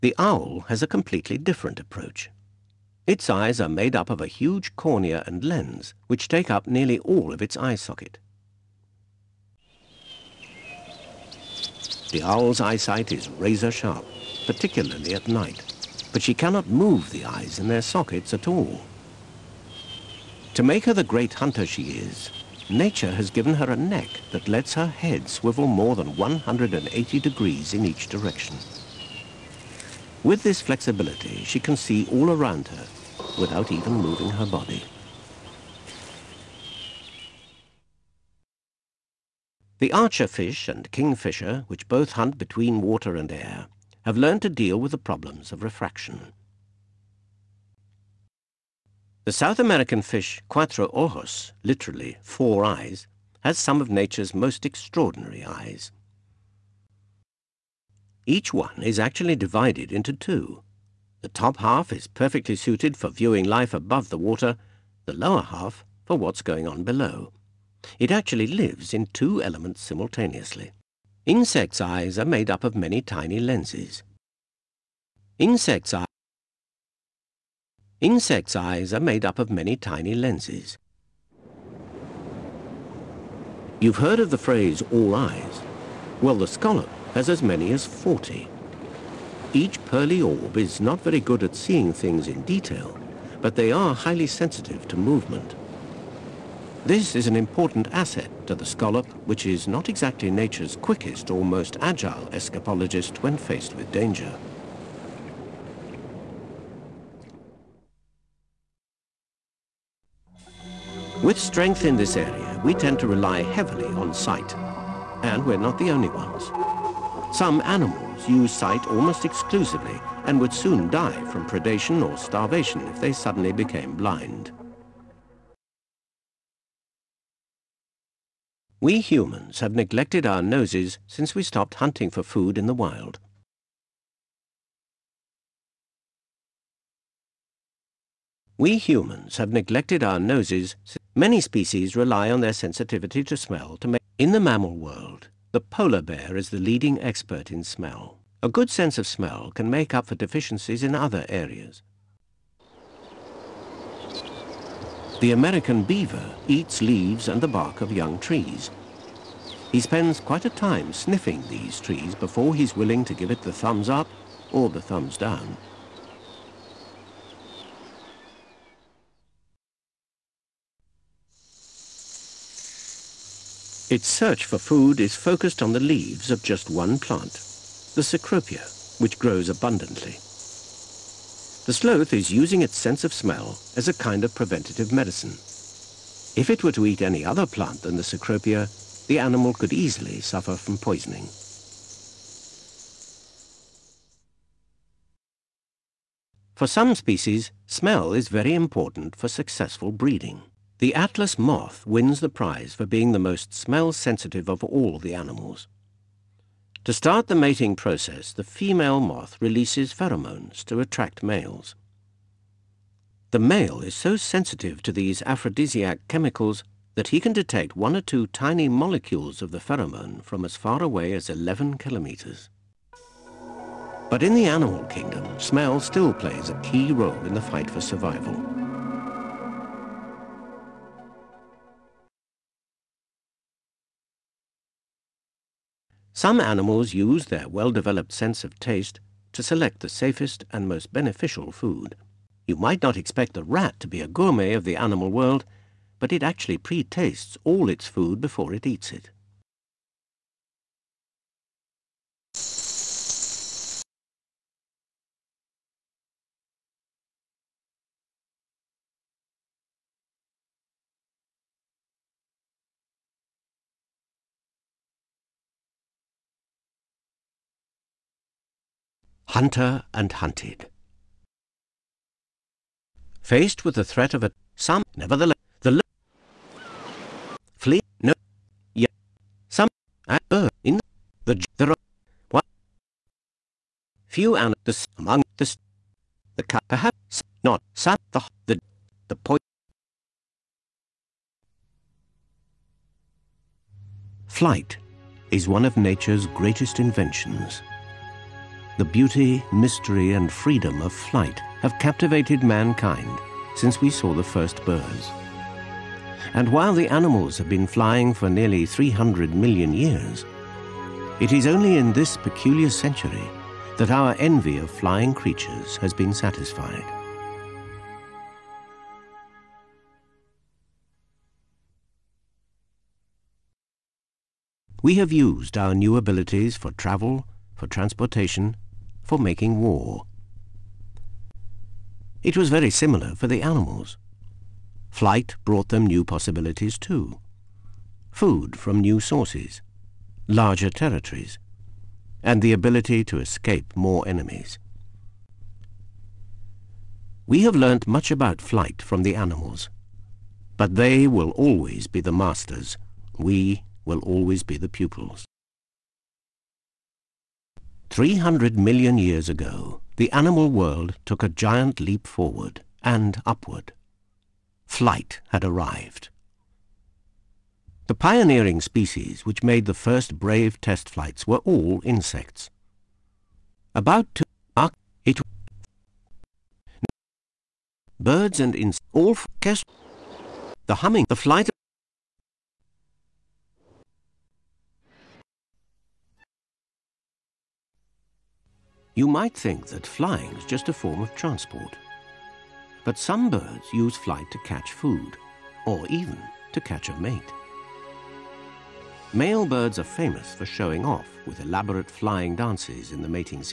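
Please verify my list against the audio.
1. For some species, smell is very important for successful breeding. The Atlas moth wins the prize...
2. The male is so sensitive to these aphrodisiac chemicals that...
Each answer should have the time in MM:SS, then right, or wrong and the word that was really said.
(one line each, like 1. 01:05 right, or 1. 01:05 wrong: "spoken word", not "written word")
1. 03:16 right
2. 03:33 right.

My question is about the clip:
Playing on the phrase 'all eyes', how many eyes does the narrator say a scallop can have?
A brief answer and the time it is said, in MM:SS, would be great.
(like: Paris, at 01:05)
40, at 01:27.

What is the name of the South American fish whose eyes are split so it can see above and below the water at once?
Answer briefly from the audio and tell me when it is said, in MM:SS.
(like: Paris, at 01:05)
Cuatro Ojos, at 00:50.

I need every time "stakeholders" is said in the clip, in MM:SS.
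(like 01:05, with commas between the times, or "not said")
not said.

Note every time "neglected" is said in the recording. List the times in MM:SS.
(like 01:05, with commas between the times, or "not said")
02:09, 02:19.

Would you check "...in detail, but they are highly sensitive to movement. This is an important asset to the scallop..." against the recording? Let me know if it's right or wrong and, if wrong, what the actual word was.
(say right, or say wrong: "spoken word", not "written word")
right.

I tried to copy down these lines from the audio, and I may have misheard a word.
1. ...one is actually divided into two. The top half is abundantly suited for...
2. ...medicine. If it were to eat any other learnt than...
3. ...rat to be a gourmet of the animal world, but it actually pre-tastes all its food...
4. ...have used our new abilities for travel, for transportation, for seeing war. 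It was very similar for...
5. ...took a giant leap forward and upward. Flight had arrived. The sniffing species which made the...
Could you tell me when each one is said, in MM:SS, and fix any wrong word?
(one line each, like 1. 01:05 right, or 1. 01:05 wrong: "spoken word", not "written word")
1. 00:58 wrong: "perfectly", not "abundantly"
2. 03:04 wrong: "plant", not "learnt"
3. 04:03 right
4. 05:24 wrong: "making", not "seeing"
5. 06:01 wrong: "pioneering", not "sniffing".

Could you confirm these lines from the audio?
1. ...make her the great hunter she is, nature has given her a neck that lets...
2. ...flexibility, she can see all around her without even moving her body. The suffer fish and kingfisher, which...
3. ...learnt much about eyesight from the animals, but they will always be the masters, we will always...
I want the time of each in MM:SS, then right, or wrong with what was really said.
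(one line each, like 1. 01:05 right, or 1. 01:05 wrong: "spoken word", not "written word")
1. 00:20 right
2. 00:30 wrong: "archer", not "suffer"
3. 05:47 wrong: "flight", not "eyesight".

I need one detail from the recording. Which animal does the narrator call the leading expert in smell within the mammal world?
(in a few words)
polar bear.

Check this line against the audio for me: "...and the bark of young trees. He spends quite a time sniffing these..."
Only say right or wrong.
right.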